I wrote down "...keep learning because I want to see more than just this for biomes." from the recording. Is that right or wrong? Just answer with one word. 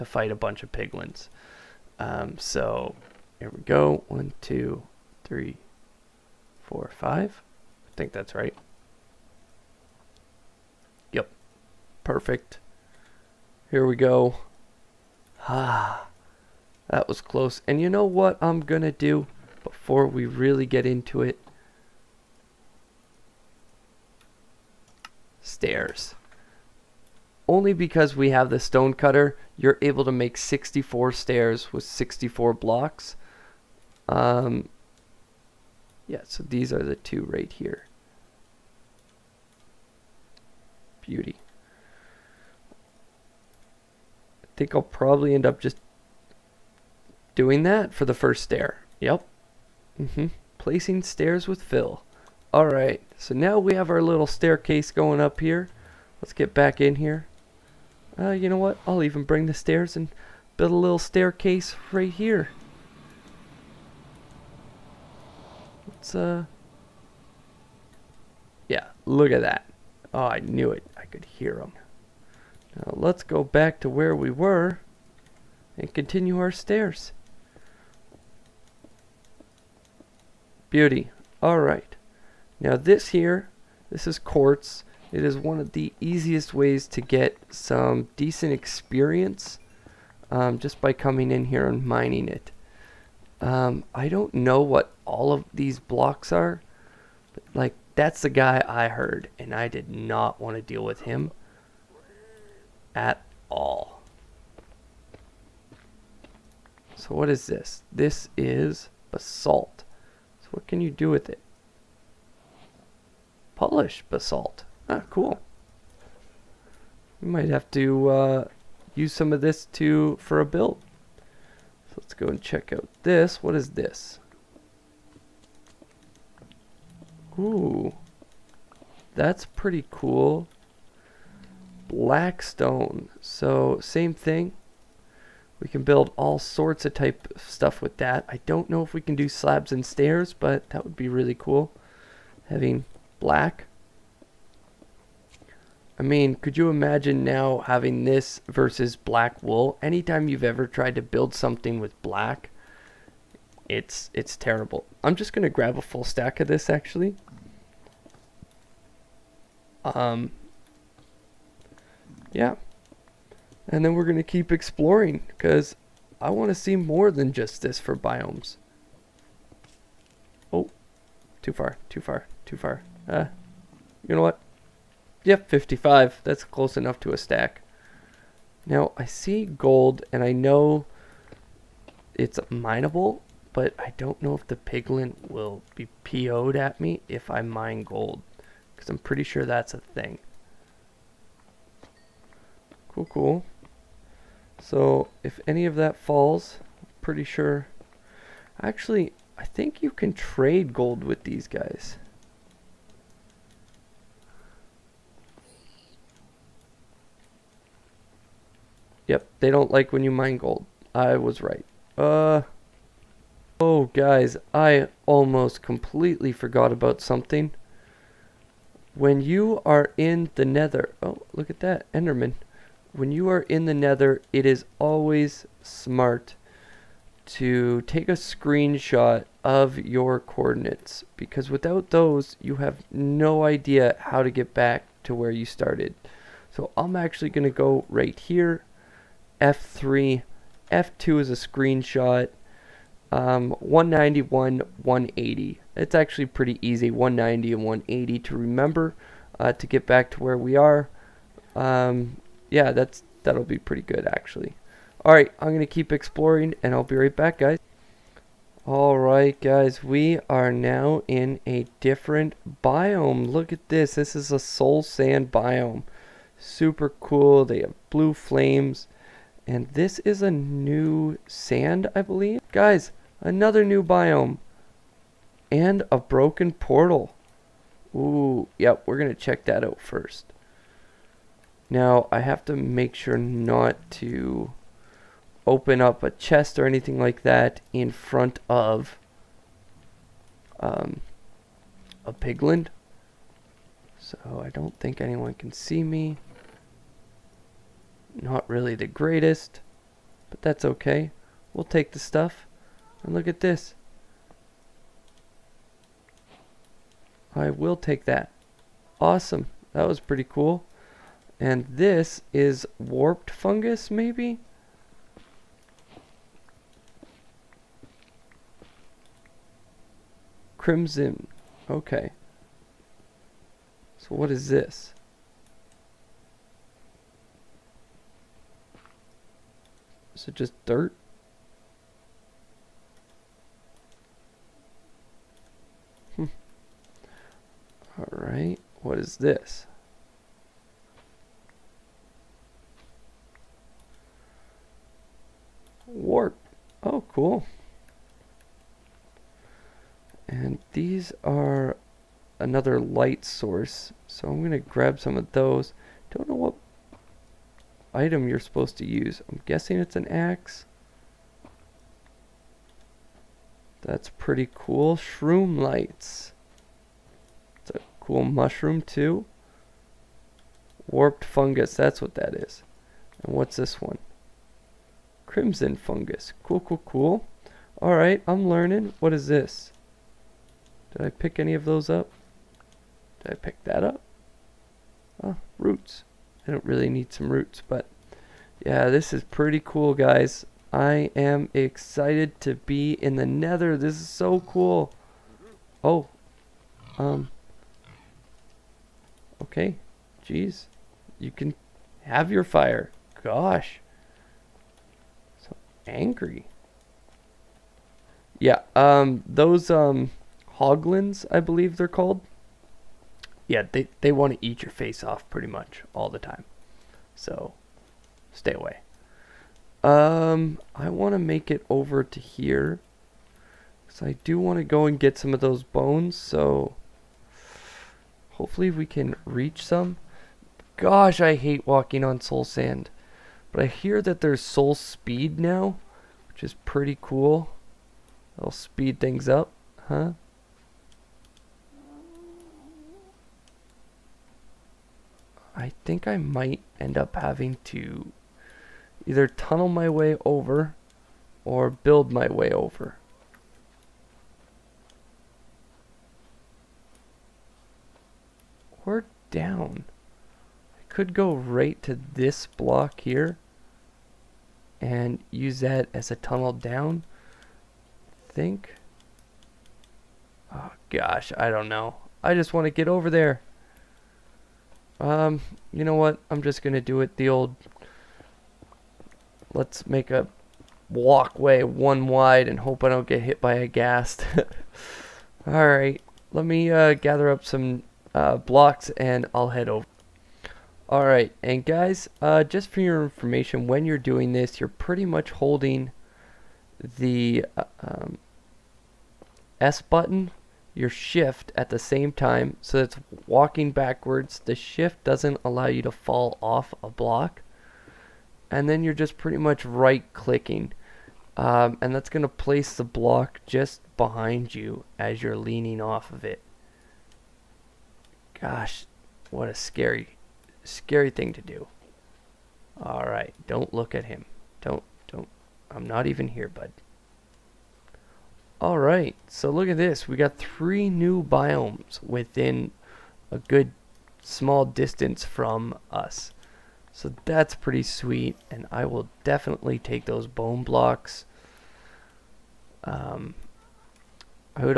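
wrong.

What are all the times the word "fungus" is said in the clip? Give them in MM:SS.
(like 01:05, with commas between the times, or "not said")
05:13, 06:11, 06:15.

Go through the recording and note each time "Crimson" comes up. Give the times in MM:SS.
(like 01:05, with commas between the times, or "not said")
05:20, 06:15.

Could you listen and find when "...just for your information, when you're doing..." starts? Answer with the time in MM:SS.
08:12.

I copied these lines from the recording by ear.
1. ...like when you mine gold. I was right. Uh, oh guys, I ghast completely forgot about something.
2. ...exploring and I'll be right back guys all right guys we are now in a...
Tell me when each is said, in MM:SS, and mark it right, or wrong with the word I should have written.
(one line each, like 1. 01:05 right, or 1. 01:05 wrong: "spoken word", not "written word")
1. 03:29 wrong: "almost", not "ghast"
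2. 04:15 right.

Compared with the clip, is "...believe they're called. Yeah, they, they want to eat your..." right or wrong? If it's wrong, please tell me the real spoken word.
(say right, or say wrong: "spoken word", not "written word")
right.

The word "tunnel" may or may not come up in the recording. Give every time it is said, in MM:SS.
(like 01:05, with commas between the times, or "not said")
07:29, 07:46.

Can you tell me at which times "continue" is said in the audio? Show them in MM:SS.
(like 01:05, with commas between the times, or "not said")
01:15.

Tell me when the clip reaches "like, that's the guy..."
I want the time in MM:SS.
01:37.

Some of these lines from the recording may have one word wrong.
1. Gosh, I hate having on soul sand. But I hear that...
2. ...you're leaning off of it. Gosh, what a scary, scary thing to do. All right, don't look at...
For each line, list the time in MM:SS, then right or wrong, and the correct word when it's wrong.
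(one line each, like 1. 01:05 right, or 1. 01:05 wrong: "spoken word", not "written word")
1. 07:10 wrong: "walking", not "having"
2. 08:35 right.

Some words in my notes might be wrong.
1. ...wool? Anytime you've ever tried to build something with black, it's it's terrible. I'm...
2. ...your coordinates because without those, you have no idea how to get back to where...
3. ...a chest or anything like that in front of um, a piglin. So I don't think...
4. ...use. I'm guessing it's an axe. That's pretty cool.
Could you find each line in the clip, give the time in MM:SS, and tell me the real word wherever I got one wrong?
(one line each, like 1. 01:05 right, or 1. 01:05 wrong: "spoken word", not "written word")
1. 02:29 right
2. 03:49 right
3. 04:46 right
4. 05:58 right.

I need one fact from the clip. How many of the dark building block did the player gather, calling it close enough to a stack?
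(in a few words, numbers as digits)
55.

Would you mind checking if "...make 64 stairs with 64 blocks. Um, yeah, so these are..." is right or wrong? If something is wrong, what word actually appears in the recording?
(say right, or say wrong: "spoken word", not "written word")
right.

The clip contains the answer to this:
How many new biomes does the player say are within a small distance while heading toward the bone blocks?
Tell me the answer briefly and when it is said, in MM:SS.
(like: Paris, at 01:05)
3, at 08:50.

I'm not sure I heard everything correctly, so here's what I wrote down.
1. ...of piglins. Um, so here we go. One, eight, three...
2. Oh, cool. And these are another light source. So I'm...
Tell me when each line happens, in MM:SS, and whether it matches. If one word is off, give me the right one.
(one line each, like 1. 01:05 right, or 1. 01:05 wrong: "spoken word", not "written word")
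1. 00:00 wrong: "two", not "eight"
2. 05:46 right.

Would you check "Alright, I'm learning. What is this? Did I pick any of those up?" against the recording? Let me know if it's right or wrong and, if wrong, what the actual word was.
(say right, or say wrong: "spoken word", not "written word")
right.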